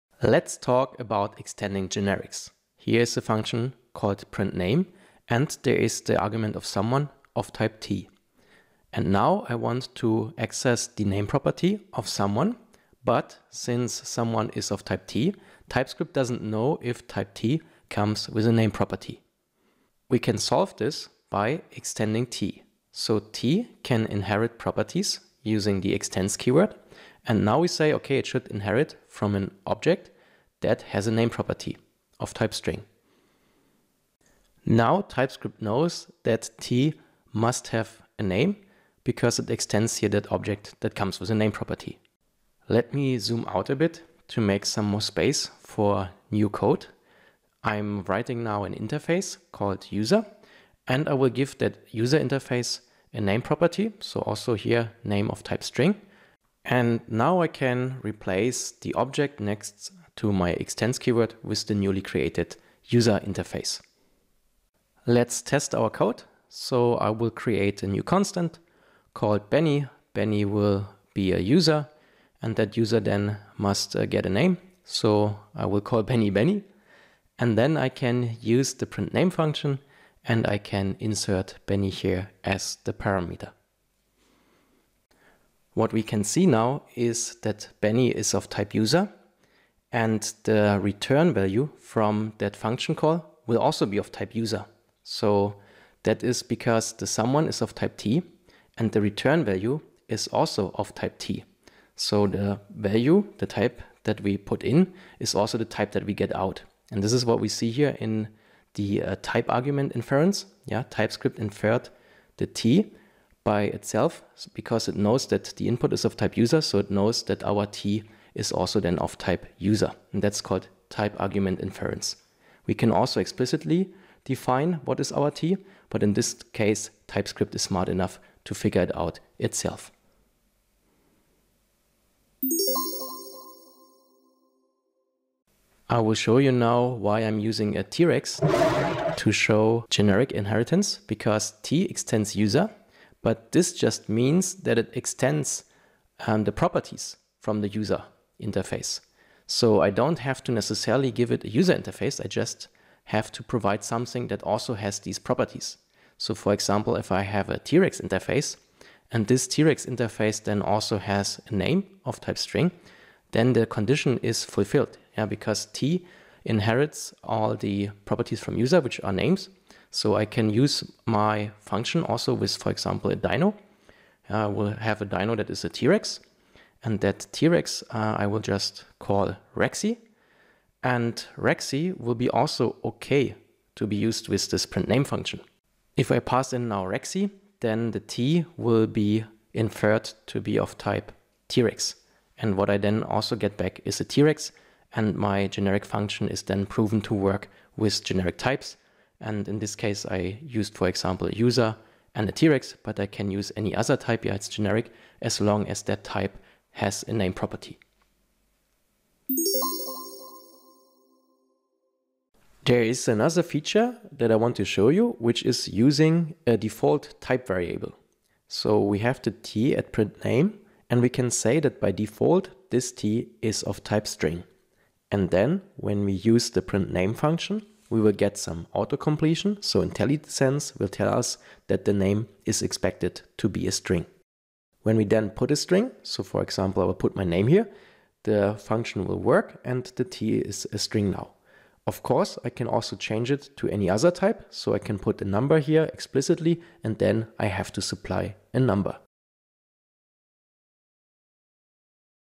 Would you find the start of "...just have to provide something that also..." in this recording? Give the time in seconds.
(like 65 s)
152 s.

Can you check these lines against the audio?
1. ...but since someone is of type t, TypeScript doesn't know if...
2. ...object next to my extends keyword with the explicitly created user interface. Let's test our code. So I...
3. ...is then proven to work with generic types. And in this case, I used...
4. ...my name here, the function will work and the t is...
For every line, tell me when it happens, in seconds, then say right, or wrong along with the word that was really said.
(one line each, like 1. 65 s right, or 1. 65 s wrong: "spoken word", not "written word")
1. 13 s right
2. 58 s wrong: "newly", not "explicitly"
3. 196 s right
4. 237 s right.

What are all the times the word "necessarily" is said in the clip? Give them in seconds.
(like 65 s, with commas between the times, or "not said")
150 s.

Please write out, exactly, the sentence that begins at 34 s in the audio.
Now TypeScript knows that t must have a name because it extends here that object that comes with a name property.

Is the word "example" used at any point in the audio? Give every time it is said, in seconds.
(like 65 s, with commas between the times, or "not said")
156 s, 172 s, 200 s, 236 s.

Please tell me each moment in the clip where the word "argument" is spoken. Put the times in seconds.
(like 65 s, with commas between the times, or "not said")
6 s, 109 s, 121 s.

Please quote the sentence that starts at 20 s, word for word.
We can solve this by extending t.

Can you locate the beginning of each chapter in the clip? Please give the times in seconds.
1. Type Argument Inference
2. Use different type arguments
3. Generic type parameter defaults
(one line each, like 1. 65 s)
1. 102 s
2. 133 s
3. 209 s.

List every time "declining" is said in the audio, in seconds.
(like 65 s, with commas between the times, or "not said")
not said.